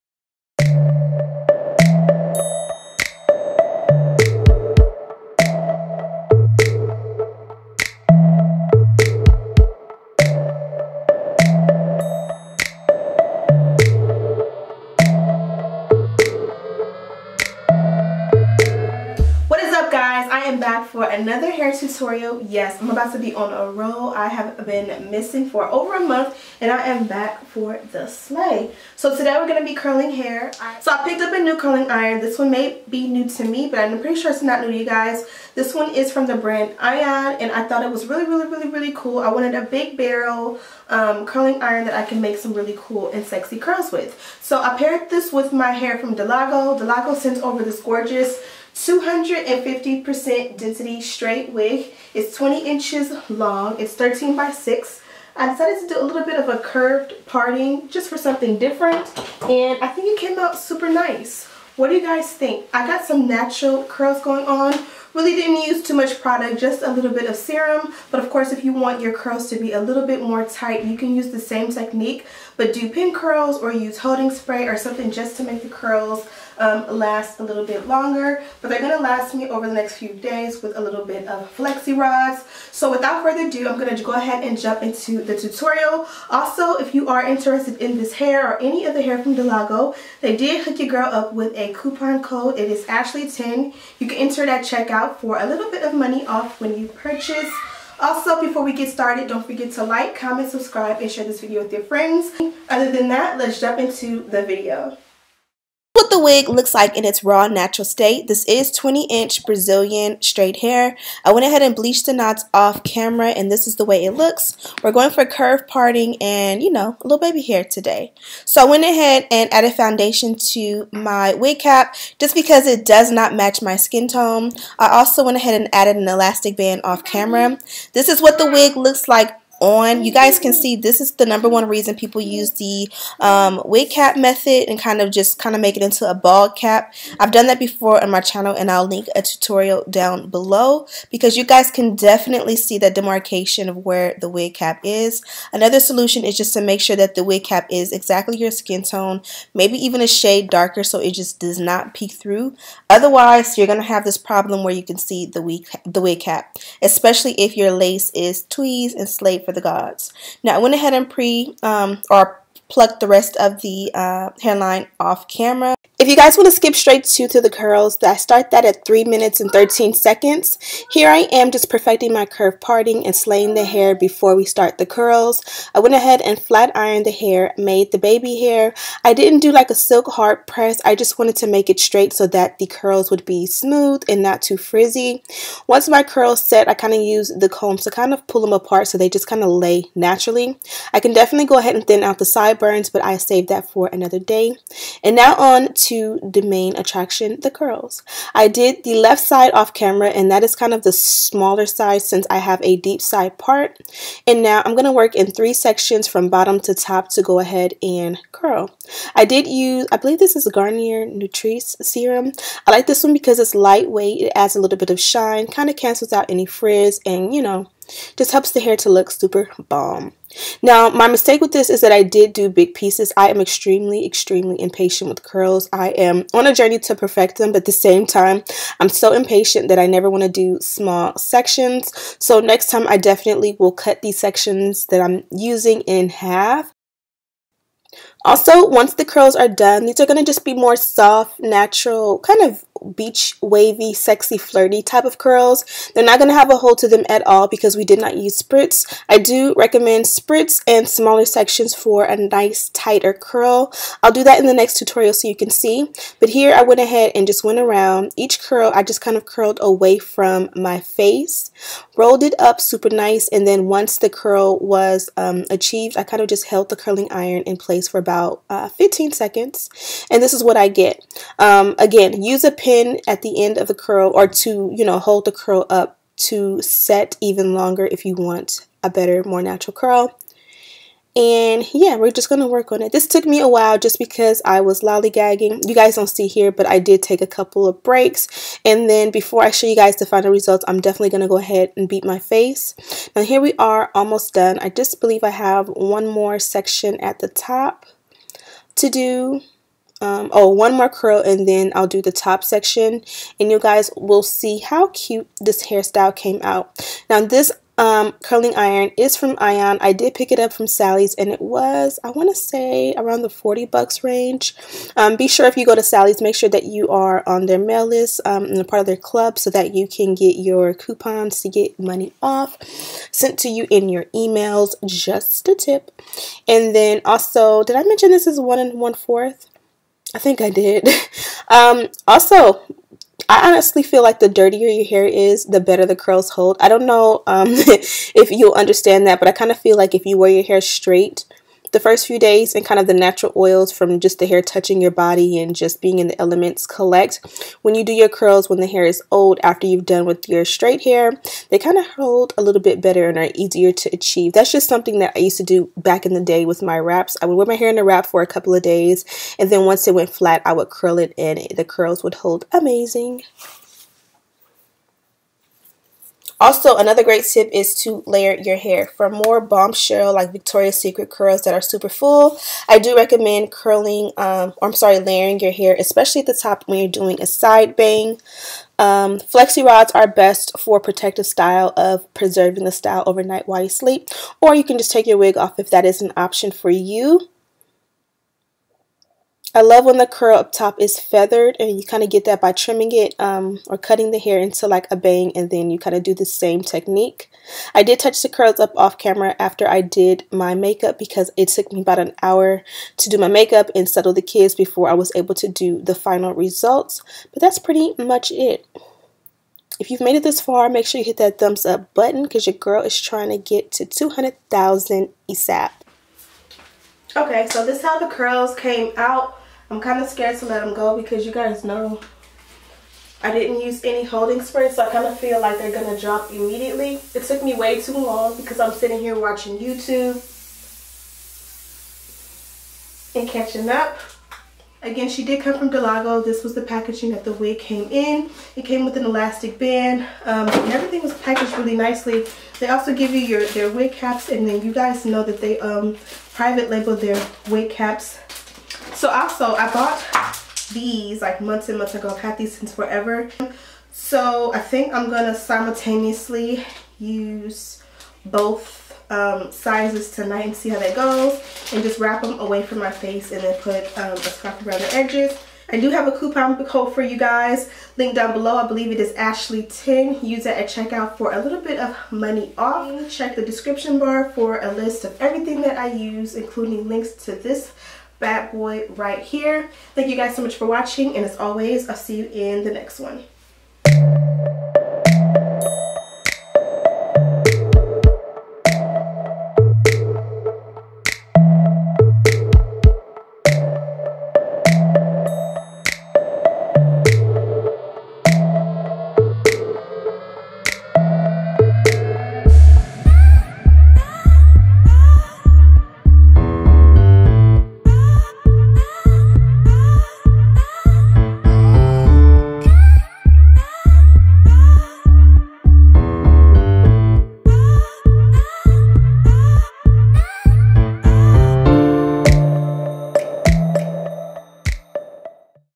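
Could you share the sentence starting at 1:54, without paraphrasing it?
We're going for curve parting and you know a little baby hair today.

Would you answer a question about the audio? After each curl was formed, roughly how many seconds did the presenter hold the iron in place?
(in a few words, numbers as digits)
15.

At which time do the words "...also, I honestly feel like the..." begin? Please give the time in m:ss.
5:32.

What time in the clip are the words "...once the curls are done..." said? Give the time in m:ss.
3:58.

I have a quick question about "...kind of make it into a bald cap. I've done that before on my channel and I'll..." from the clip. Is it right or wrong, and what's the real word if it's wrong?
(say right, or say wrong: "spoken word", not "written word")
right.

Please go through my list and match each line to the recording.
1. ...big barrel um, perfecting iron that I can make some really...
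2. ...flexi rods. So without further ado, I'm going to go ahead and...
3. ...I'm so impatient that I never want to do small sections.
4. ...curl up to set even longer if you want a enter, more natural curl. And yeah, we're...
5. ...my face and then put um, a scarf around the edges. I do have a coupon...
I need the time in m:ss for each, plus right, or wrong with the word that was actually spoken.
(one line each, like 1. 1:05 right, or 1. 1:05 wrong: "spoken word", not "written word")
1. 0:39 wrong: "curling", not "perfecting"
2. 1:21 right
3. 3:48 right
4. 4:35 wrong: "better", not "enter"
5. 7:42 right.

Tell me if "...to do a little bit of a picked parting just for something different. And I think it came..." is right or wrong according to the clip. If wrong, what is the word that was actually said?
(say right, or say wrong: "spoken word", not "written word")
wrong: "curved", not "picked".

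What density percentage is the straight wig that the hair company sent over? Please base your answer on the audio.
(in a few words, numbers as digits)
250%.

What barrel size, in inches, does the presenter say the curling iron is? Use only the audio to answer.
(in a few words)
1 1/4 inch.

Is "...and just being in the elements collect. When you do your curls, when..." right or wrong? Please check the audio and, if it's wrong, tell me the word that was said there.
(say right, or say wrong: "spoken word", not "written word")
right.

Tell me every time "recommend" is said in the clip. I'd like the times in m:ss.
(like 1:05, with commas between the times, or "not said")
4:09, 6:12.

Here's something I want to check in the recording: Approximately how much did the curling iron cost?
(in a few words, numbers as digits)
$40.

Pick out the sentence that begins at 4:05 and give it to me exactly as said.
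They're not going to have a hold to them at all because we did not use spritz.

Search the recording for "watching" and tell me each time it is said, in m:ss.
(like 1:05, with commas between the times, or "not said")
7:09, 8:00.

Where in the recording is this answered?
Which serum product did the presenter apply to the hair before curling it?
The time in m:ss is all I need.
3:30.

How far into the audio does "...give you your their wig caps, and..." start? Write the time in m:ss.
7:22.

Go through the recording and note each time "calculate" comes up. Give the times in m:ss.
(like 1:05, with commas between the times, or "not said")
not said.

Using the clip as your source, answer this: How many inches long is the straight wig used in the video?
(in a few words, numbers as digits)
20 inches.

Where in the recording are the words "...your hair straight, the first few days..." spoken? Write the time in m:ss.
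5:40.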